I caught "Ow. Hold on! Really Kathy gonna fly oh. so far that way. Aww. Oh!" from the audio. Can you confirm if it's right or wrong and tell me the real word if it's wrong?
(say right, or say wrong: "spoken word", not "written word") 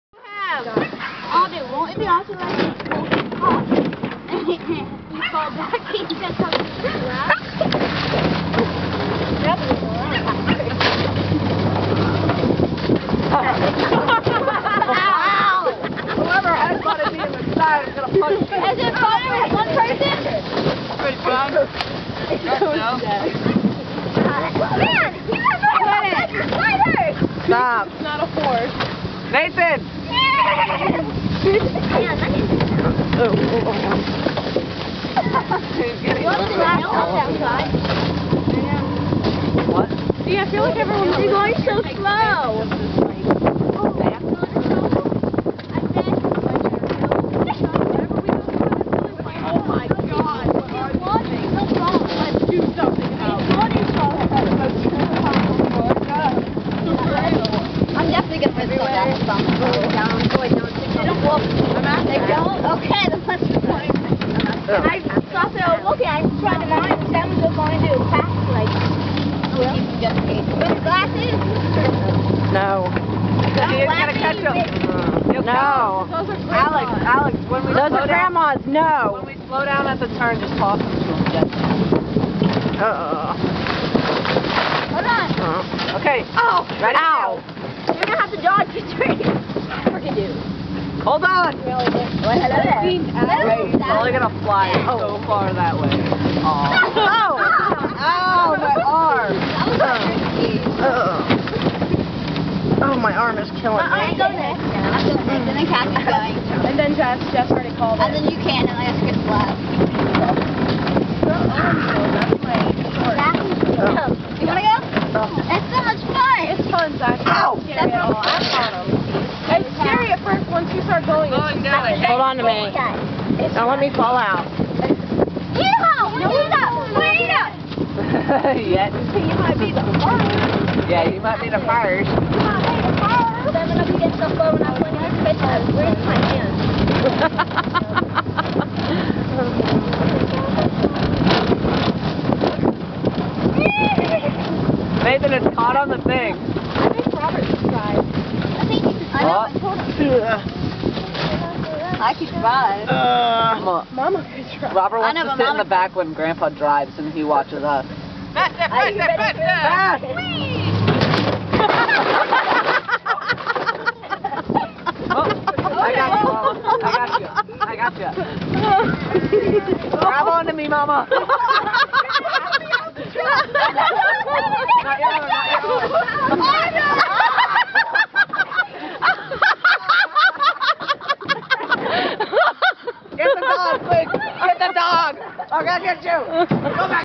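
wrong: "Probably", not "Kathy".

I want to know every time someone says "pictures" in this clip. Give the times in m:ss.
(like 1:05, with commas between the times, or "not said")
2:15.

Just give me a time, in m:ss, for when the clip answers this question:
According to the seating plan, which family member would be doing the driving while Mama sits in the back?
2:36.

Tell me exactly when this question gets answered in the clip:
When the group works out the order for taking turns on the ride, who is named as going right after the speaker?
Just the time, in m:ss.
1:45.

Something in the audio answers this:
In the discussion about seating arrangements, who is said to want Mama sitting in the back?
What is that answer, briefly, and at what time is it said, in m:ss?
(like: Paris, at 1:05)
Robert, at 2:34.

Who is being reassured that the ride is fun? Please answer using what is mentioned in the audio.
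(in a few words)
Zach.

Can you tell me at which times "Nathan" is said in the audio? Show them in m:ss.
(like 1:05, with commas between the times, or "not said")
0:29, 2:25.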